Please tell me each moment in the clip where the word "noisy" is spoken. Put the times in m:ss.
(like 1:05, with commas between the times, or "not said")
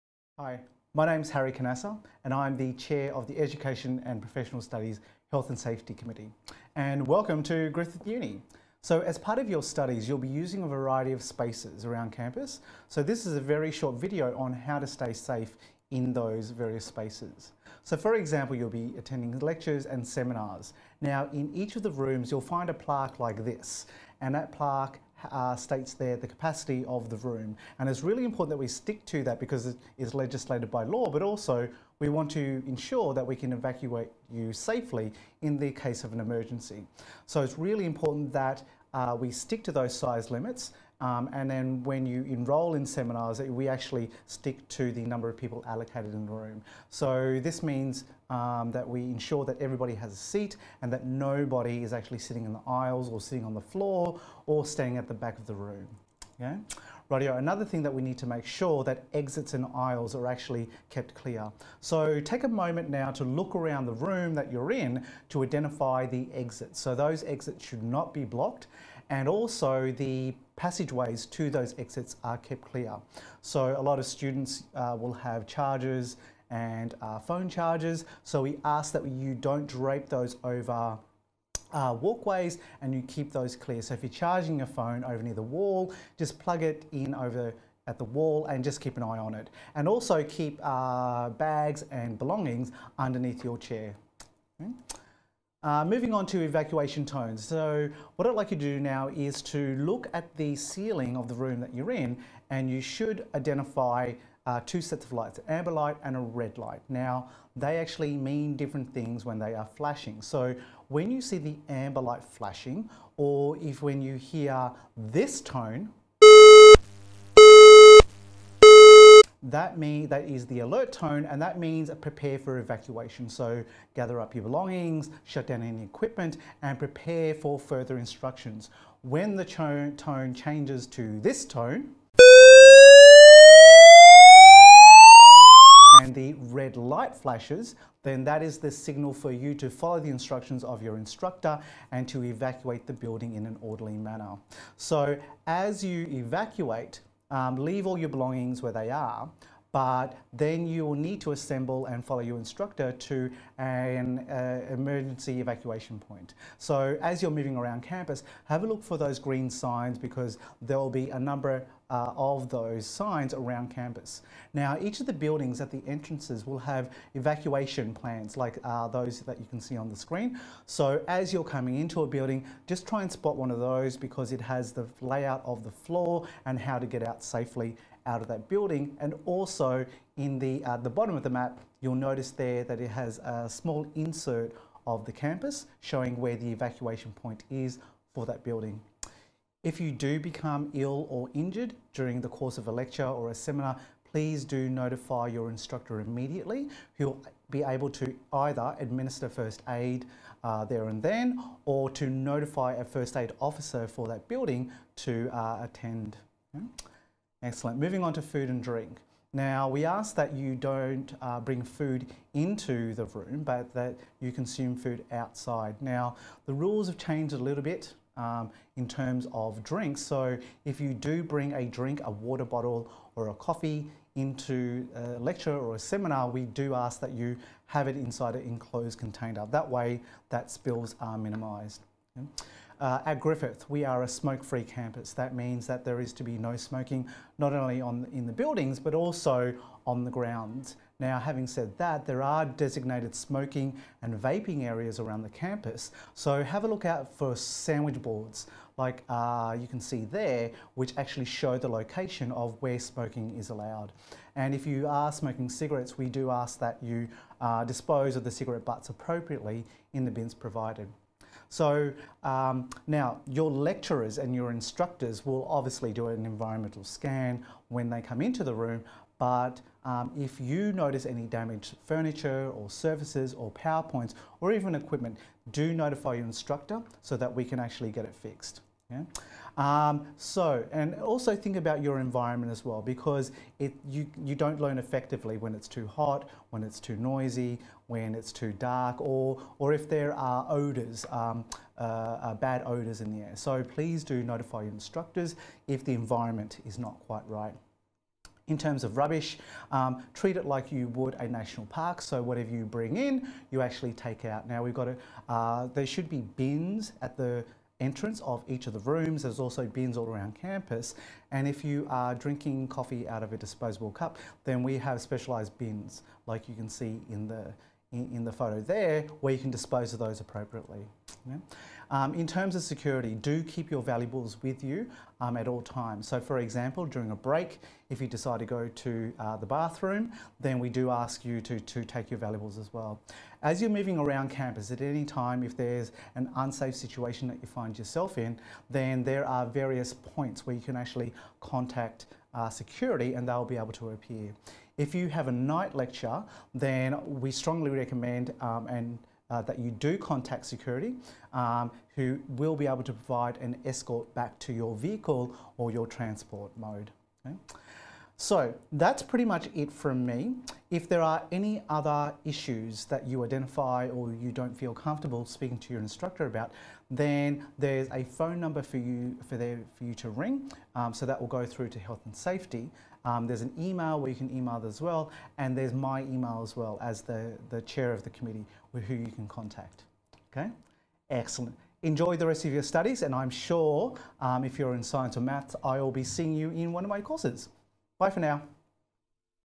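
4:46.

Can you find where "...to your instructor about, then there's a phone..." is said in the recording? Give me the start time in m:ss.
6:05.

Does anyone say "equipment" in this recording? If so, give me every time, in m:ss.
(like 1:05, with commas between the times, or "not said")
2:05, 4:34.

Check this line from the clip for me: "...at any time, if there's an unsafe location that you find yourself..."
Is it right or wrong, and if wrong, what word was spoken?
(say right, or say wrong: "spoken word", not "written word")
wrong: "situation", not "location".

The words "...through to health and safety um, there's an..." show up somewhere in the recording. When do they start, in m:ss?
6:11.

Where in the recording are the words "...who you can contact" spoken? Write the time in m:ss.
6:18.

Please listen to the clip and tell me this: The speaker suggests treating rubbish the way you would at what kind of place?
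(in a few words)
A national park.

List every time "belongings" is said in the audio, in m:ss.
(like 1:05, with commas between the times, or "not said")
1:32, 2:04, 2:28.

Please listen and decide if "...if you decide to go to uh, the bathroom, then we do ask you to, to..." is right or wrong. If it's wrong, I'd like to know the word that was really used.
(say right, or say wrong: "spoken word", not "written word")
right.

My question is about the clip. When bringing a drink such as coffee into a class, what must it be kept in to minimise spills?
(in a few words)
An enclosed container.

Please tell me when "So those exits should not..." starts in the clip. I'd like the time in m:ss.
1:06.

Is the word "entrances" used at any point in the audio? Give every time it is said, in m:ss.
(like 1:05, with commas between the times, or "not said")
2:45, 5:07.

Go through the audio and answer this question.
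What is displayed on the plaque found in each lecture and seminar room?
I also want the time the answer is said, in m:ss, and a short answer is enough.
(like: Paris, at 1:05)
The capacity of the room, at 0:26.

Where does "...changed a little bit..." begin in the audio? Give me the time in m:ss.
3:36.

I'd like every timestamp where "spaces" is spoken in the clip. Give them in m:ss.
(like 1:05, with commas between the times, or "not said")
0:11, 0:16.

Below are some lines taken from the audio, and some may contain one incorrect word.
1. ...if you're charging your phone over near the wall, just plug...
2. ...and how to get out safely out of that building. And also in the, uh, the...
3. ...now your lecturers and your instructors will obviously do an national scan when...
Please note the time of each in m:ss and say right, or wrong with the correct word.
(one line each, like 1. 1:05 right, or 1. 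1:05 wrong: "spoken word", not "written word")
1. 1:23 right
2. 2:56 right
3. 4:22 wrong: "environmental", not "national".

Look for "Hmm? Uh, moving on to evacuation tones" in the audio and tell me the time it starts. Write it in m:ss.
1:34.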